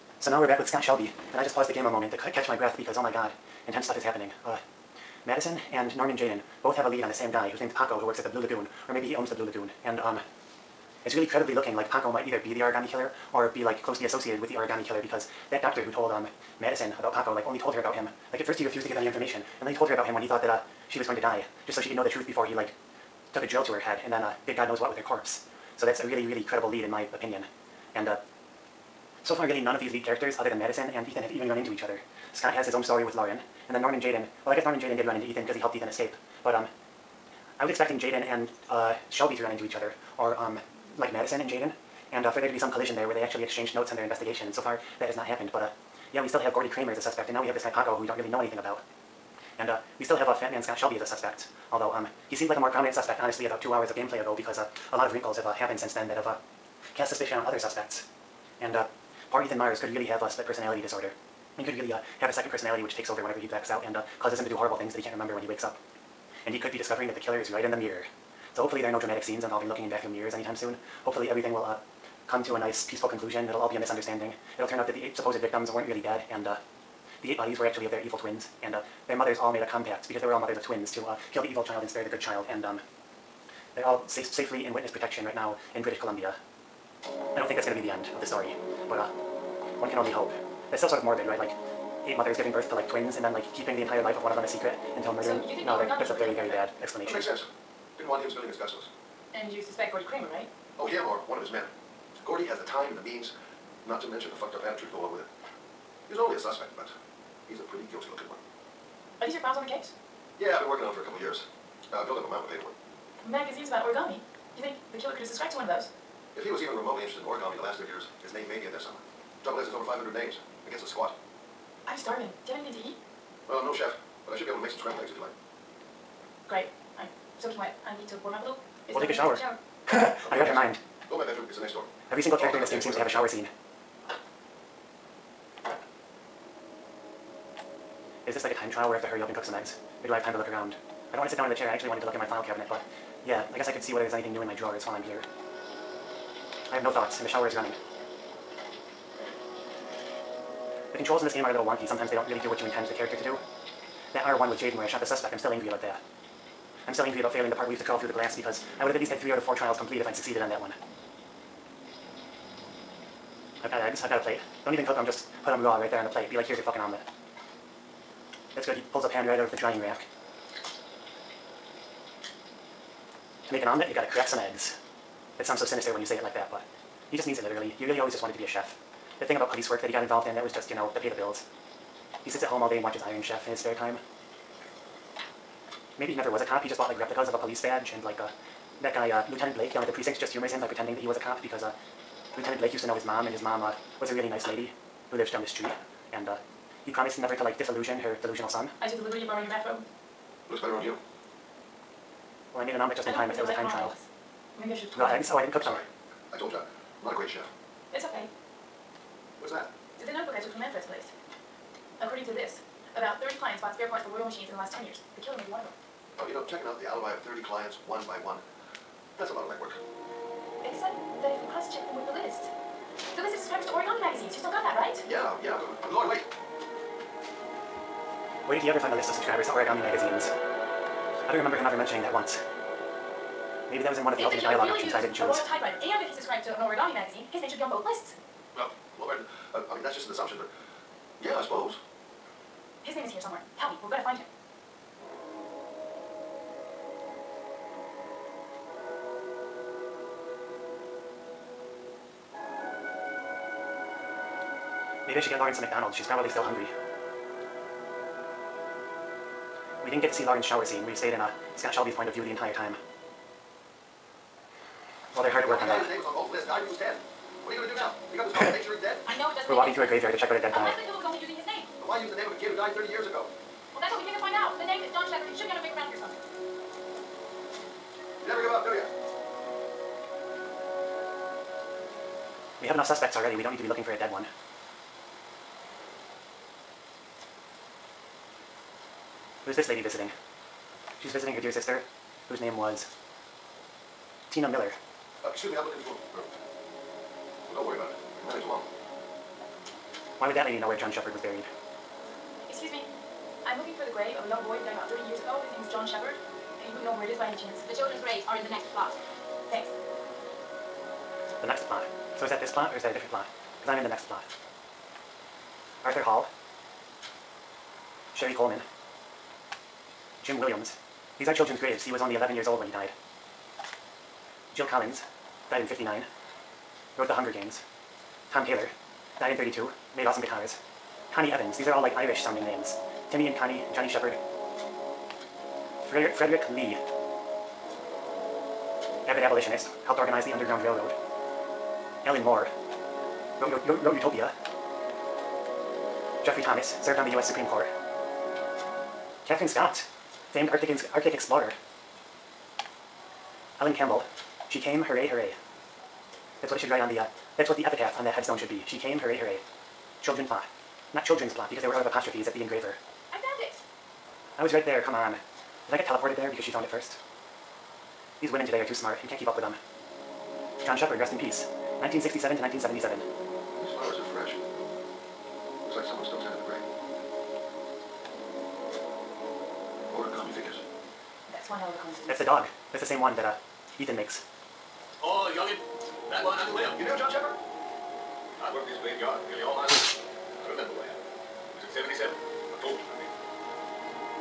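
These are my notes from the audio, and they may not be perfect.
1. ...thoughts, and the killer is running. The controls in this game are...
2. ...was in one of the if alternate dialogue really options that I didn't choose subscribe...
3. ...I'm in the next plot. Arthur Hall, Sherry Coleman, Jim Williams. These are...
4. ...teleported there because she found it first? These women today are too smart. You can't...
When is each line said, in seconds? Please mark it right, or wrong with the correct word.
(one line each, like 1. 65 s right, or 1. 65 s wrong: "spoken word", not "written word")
1. 146 s wrong: "shower", not "killer"
2. 233 s right
3. 313 s right
4. 365 s right.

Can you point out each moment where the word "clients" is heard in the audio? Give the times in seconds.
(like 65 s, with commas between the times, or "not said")
213 s, 217 s.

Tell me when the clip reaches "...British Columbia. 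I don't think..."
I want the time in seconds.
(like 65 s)
85 s.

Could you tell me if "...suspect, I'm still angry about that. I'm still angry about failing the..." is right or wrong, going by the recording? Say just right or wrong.
right.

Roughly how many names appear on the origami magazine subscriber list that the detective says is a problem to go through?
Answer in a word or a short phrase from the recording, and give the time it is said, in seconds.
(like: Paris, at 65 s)
500, at 119 s.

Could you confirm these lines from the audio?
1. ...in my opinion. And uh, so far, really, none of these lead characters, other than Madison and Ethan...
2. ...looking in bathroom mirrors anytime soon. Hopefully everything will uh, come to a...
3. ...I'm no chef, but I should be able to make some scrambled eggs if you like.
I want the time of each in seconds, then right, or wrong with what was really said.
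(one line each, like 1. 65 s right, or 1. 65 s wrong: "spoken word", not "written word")
1. 26 s right
2. 69 s right
3. 123 s right.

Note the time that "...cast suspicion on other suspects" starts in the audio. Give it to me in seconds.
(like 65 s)
56 s.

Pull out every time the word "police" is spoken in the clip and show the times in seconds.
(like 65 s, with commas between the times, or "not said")
179 s, 187 s.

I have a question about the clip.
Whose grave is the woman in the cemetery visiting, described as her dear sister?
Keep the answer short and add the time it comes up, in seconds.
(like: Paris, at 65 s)
Tina Miller, at 294 s.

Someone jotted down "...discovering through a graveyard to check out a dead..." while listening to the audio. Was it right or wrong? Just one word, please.
wrong.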